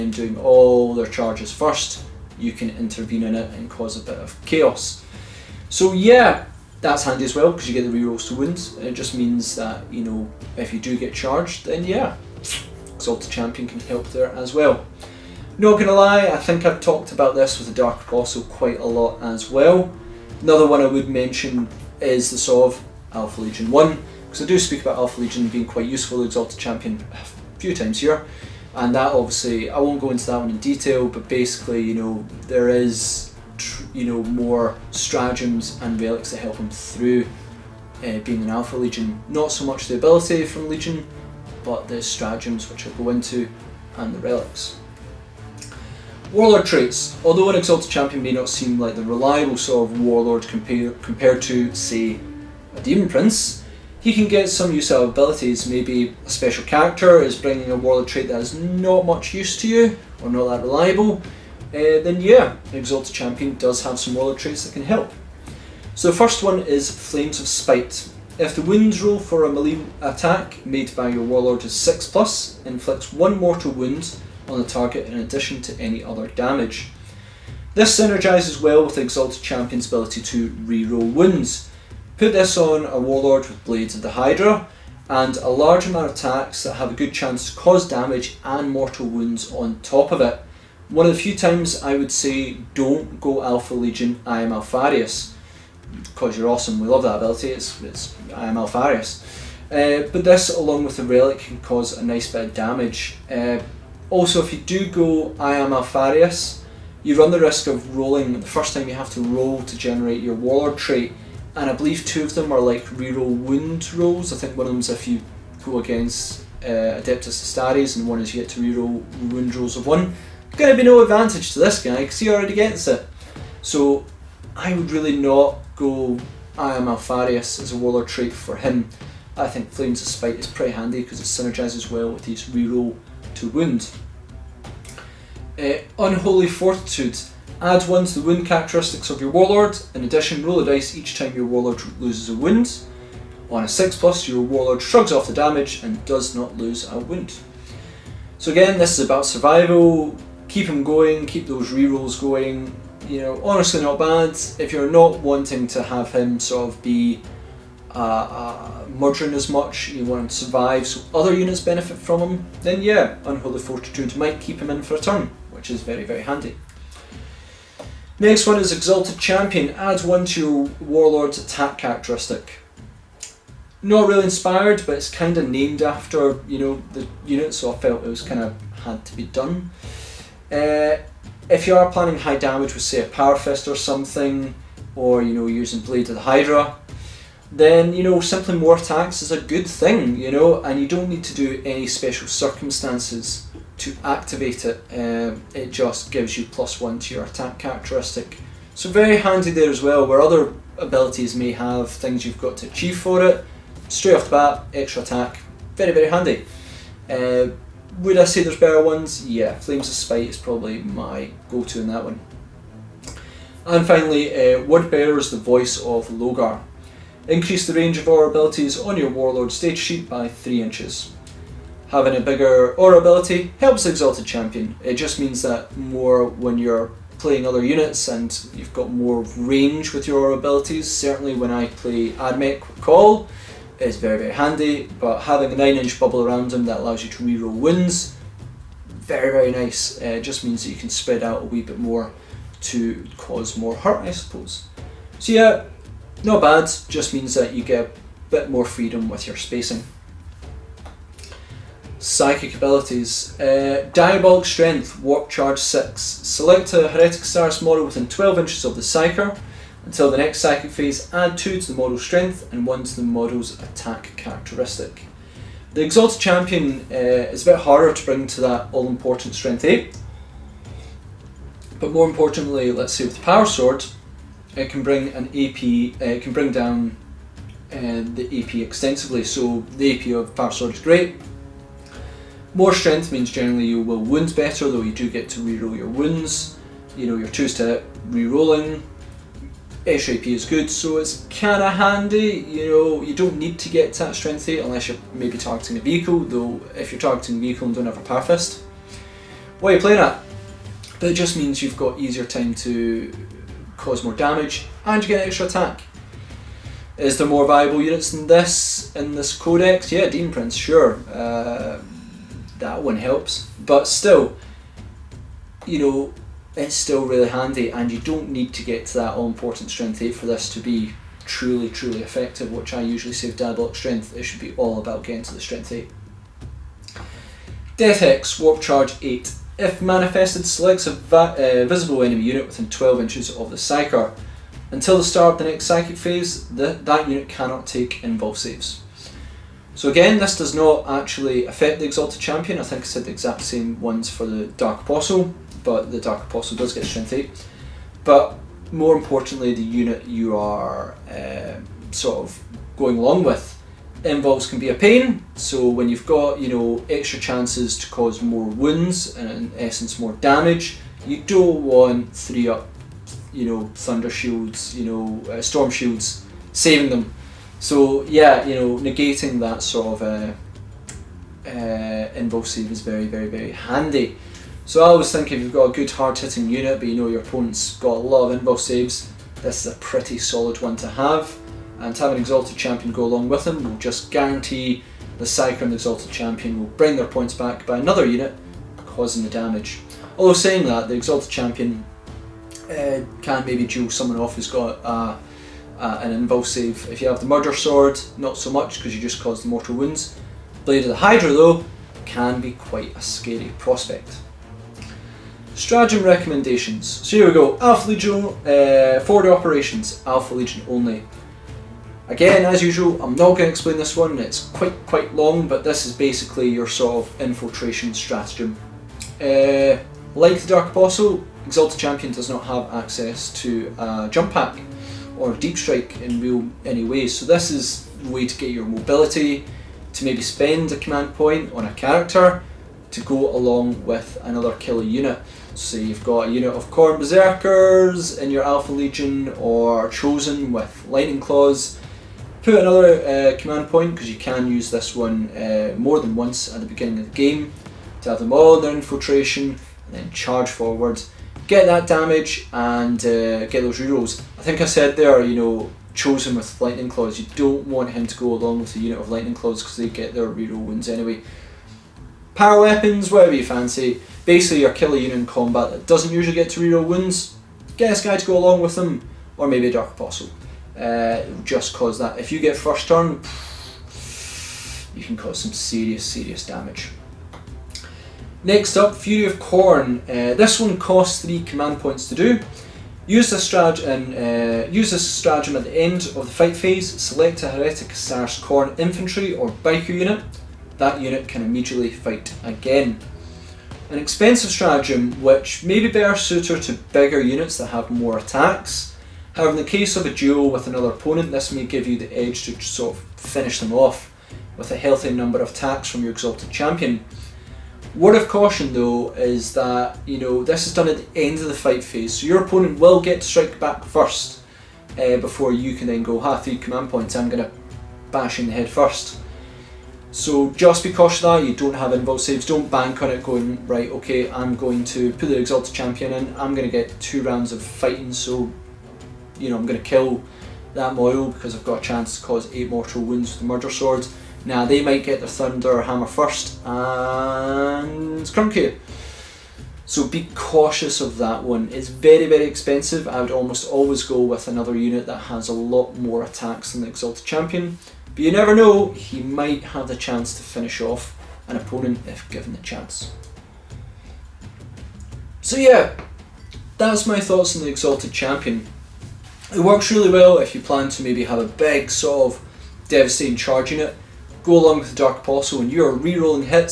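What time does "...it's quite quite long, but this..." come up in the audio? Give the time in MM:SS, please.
06:54.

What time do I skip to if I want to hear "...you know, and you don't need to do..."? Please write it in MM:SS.
03:10.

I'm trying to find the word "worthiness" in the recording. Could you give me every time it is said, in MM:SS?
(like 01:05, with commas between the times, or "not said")
not said.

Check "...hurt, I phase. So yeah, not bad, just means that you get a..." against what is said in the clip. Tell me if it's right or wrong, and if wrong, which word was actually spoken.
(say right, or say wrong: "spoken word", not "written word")
wrong: "suppose", not "phase".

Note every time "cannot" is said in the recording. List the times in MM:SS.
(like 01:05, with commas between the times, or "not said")
05:37.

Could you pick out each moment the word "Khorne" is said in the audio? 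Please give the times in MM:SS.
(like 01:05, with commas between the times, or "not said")
07:16, 07:59, 08:08.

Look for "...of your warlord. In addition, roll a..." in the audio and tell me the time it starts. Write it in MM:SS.
02:19.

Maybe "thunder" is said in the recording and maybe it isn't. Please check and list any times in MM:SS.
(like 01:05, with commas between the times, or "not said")
06:03, 08:55.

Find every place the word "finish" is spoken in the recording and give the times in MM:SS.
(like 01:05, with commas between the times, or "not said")
08:23, 09:10.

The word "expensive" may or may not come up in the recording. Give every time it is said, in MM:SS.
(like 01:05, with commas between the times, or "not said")
08:13, 09:02.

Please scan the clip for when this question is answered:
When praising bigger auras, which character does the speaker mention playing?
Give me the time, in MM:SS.
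03:52.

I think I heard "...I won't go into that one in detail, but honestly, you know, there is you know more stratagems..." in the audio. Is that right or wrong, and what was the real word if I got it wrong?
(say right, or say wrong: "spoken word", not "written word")
wrong: "basically", not "honestly".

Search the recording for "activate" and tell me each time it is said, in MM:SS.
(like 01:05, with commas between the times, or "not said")
03:14.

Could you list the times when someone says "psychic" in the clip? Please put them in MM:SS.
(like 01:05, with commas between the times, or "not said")
04:11, 04:20, 05:35.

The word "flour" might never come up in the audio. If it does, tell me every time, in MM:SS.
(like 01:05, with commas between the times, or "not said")
not said.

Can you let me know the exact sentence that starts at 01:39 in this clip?
Uh, but this, along with the relic, can cause a nice bit of damage.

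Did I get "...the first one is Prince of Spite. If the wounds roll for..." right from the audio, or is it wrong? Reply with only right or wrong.
wrong.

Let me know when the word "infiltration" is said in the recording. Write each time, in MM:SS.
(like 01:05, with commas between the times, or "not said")
06:57, 07:28.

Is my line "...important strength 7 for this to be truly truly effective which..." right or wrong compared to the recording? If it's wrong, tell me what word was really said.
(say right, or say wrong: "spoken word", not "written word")
wrong: "8", not "7".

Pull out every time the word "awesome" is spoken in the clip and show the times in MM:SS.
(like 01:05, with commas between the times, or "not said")
01:36.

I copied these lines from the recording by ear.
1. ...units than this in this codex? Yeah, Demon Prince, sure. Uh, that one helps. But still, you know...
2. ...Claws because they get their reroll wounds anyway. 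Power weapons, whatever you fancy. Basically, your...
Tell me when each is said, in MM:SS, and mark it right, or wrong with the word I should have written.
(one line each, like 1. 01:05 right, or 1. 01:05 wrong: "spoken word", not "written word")
1. 05:07 right
2. 07:39 right.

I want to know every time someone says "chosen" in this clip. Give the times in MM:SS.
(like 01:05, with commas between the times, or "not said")
07:19, 07:35.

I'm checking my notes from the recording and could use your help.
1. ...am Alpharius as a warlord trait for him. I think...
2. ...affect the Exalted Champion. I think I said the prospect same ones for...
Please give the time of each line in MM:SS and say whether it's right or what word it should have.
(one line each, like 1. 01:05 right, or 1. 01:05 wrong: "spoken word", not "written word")
1. 02:06 right
2. 05:41 wrong: "exact", not "prospect".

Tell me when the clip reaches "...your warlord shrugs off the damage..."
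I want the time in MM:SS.
02:24.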